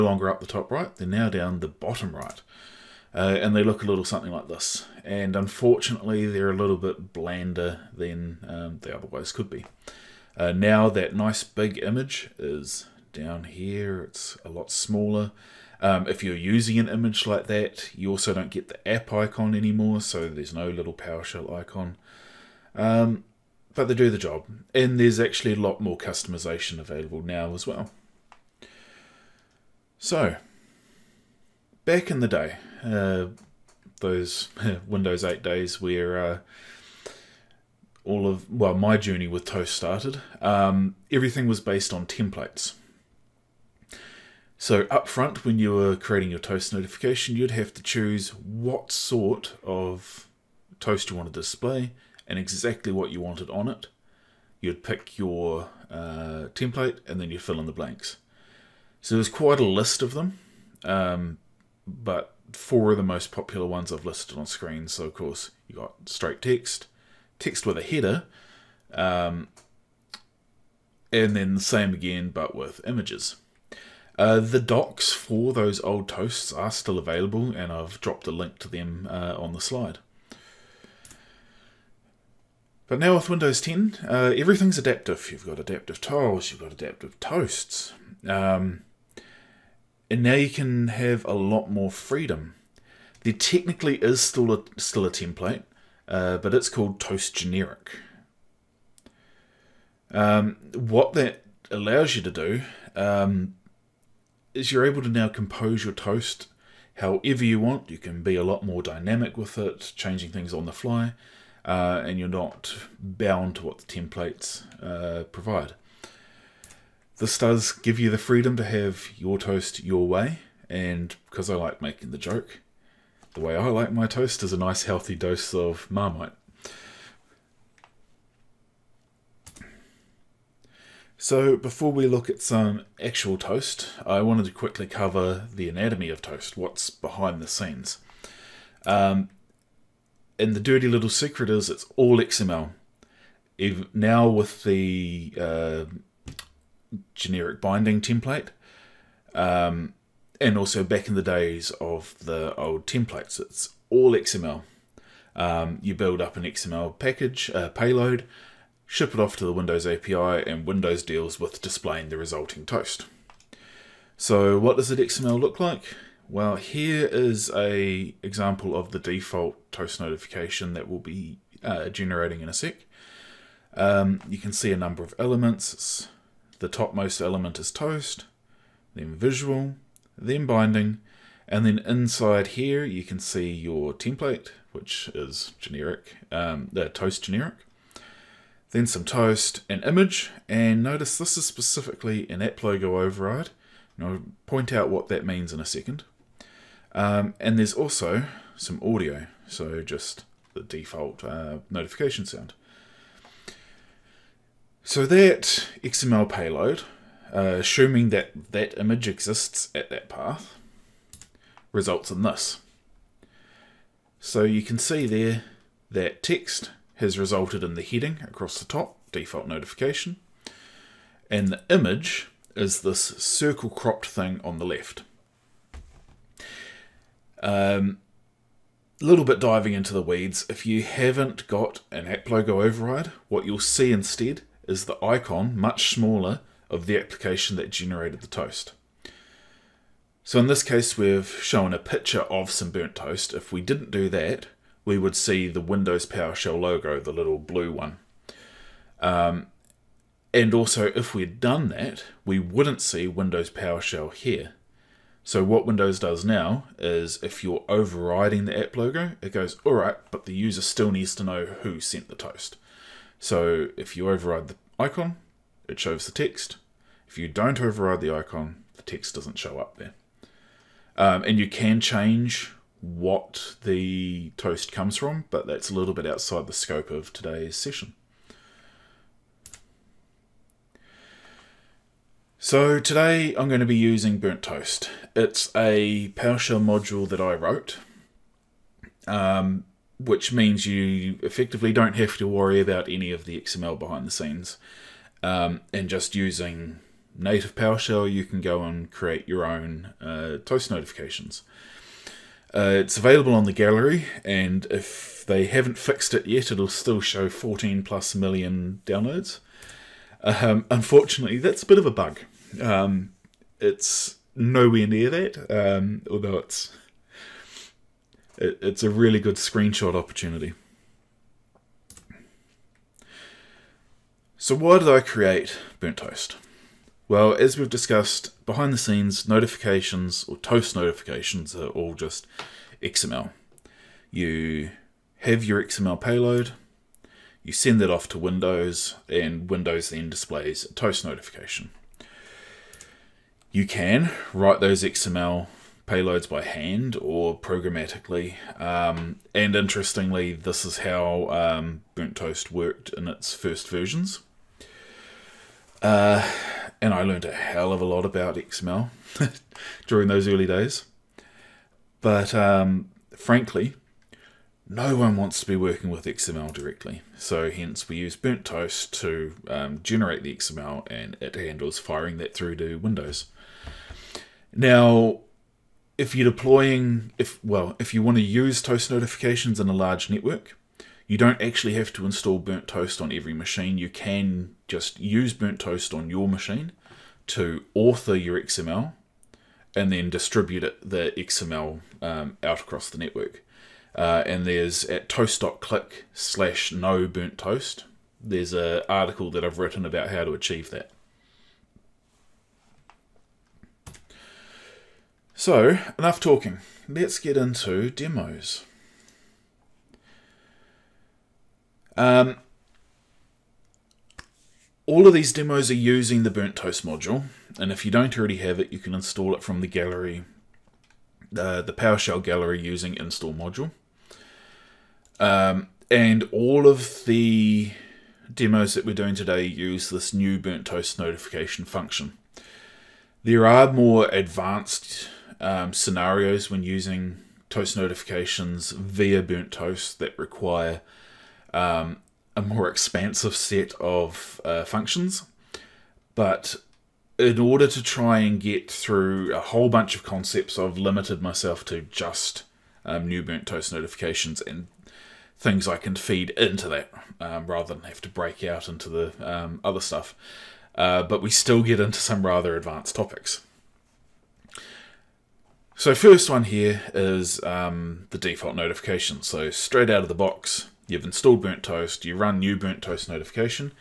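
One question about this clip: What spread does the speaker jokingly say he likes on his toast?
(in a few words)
Marmite.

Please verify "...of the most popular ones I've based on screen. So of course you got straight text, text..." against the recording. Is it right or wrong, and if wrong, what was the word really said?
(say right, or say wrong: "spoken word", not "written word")
wrong: "listed", not "based".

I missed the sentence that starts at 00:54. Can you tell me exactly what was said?
You'd pick your uh, template and then you fill in the blanks.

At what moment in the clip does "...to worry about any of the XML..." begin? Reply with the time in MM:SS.
04:52.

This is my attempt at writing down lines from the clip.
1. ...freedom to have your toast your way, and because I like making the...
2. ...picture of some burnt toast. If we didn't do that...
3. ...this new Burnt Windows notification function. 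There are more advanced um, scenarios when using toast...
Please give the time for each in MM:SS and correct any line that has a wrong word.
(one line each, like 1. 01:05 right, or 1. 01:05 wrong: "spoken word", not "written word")
1. 01:58 right
2. 04:01 right
3. 07:09 wrong: "Toast", not "Windows".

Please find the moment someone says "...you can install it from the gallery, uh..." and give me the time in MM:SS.
06:58.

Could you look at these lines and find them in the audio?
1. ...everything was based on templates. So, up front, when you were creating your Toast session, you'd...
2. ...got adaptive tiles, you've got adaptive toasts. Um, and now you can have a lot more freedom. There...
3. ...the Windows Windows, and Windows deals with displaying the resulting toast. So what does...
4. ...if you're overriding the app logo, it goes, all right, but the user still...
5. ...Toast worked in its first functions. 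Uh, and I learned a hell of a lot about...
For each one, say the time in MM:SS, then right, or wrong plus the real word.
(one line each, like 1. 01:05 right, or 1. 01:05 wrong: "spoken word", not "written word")
1. 00:41 wrong: "notification", not "session"
2. 01:25 right
3. 02:39 wrong: "API", not "Windows"
4. 04:17 right
5. 05:52 wrong: "versions", not "functions".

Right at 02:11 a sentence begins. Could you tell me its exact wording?
So, before we look at some actual toast, I wanted to quickly cover the anatomy of toast, what's behind the scenes.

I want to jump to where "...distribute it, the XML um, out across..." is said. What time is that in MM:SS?
06:30.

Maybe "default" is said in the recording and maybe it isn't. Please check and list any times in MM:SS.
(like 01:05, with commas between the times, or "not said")
02:48, 03:20, 03:39, 07:48.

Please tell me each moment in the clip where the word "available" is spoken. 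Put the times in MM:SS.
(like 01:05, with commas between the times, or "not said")
00:26, 01:16, 05:02.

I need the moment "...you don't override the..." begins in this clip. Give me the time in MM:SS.
04:27.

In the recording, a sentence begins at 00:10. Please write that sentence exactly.
Uh, now that nice big image is down here, it's a lot smaller.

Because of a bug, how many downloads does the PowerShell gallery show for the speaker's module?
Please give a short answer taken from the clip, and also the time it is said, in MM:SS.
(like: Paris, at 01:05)
14 million plus, at 05:07.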